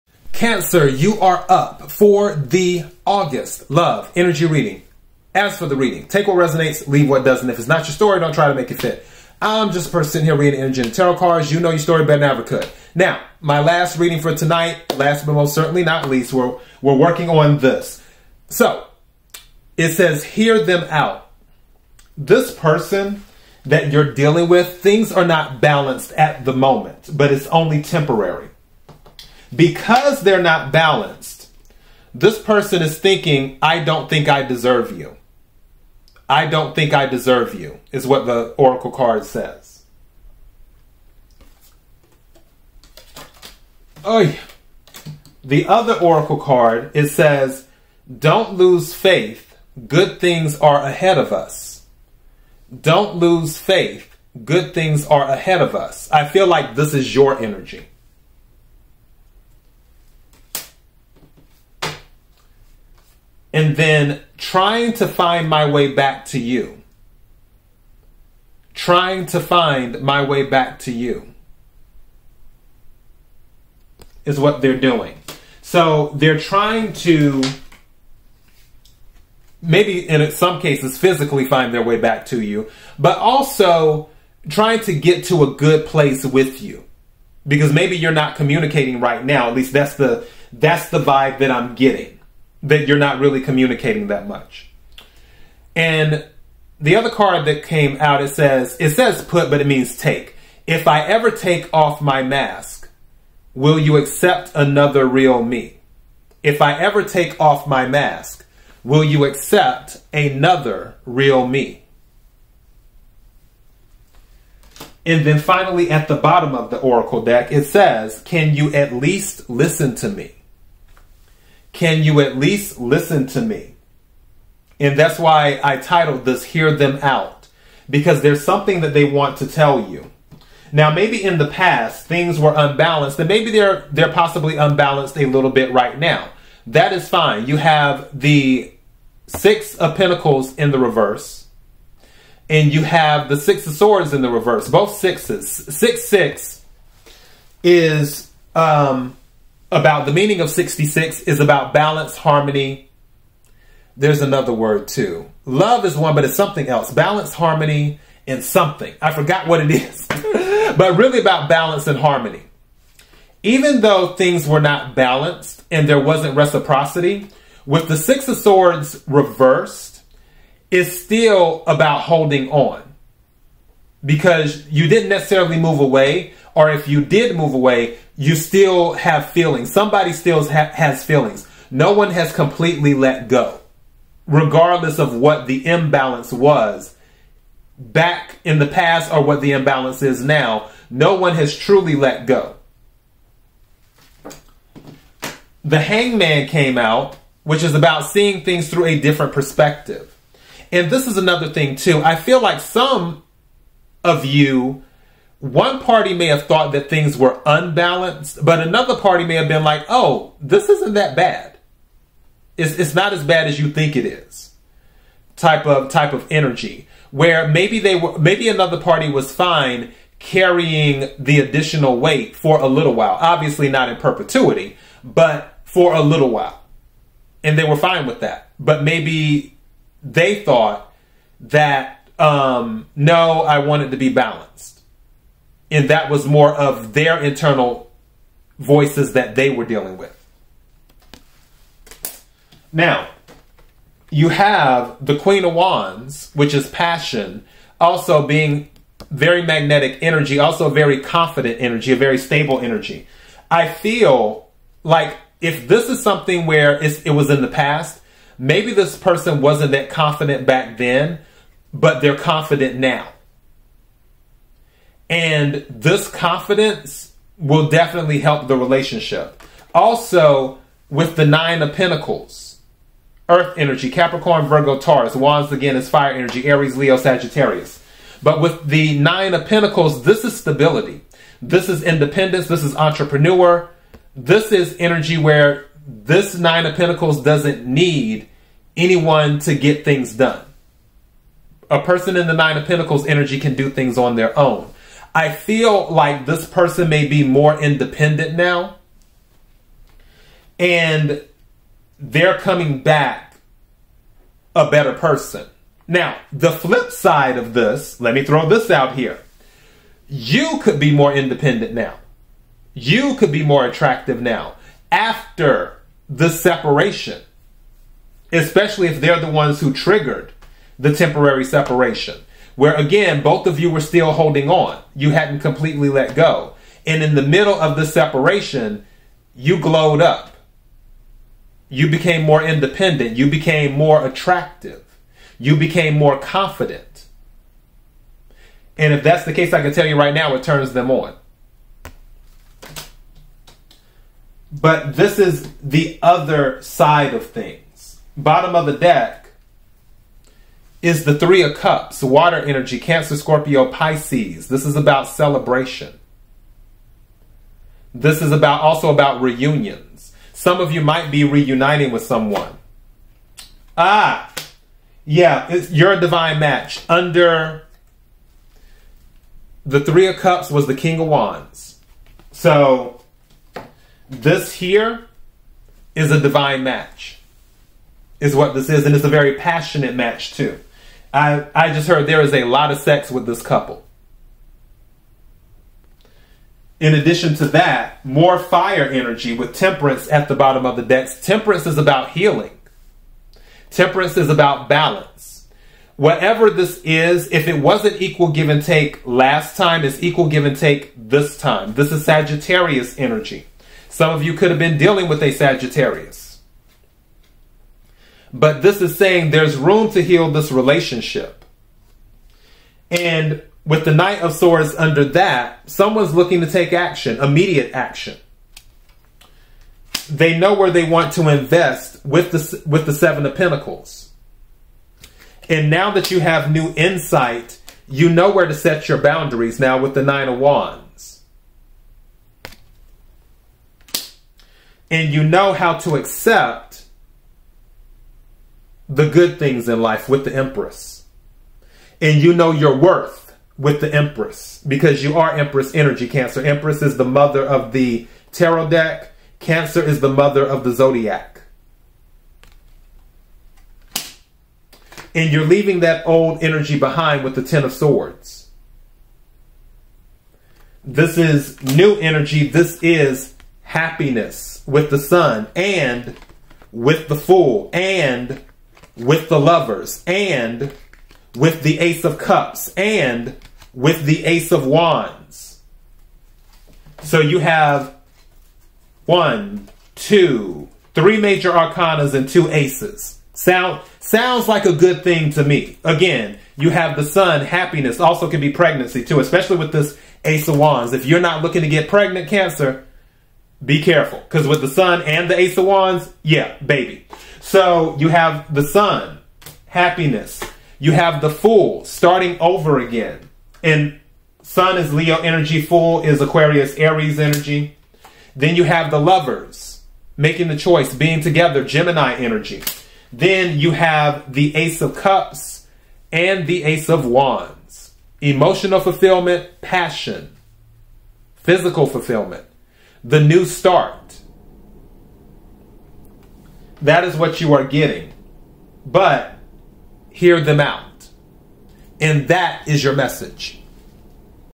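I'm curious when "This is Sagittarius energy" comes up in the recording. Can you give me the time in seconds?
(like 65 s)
401 s.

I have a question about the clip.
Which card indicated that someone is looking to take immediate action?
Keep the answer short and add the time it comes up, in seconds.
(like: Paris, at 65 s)
Knight of Swords, at 413 s.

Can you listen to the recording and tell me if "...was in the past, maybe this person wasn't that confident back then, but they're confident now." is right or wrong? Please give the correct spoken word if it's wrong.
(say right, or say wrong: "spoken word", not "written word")
right.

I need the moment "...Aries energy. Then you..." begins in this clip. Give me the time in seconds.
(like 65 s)
506 s.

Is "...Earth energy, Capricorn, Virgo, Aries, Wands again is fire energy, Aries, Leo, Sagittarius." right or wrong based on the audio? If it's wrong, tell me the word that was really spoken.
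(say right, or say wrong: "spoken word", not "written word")
wrong: "Taurus", not "Aries".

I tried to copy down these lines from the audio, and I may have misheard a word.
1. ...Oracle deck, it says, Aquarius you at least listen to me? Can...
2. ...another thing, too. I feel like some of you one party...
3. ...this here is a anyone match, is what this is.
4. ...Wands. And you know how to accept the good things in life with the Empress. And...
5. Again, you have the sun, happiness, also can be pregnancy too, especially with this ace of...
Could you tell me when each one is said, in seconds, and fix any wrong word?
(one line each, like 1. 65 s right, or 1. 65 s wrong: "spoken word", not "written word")
1. 116 s wrong: "Can", not "Aquarius"
2. 201 s right
3. 374 s wrong: "divine", not "anyone"
4. 430 s right
5. 485 s right.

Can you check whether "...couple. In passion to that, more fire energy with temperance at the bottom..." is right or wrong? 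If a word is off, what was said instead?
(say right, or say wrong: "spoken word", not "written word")
wrong: "addition", not "passion".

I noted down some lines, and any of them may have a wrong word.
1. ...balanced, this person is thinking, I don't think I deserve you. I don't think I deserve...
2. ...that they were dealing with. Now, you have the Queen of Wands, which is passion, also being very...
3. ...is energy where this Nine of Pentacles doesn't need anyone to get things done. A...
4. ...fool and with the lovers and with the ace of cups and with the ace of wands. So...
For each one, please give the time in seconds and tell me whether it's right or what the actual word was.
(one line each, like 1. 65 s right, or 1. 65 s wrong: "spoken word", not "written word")
1. 30 s right
2. 239 s right
3. 284 s right
4. 467 s right.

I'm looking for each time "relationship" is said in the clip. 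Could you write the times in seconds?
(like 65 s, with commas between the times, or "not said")
268 s, 410 s.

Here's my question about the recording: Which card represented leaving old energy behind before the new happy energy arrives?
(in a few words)
Ten of Swords.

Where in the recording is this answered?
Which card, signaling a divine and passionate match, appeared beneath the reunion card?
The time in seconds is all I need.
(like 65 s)
370 s.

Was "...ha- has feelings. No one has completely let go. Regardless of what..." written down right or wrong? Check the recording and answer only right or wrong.
right.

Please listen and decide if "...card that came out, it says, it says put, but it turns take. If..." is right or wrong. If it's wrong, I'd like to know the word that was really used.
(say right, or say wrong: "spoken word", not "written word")
wrong: "means", not "turns".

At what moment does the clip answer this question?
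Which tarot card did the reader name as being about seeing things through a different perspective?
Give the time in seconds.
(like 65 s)
195 s.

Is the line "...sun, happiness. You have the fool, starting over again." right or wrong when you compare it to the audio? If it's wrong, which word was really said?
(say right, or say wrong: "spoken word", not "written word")
right.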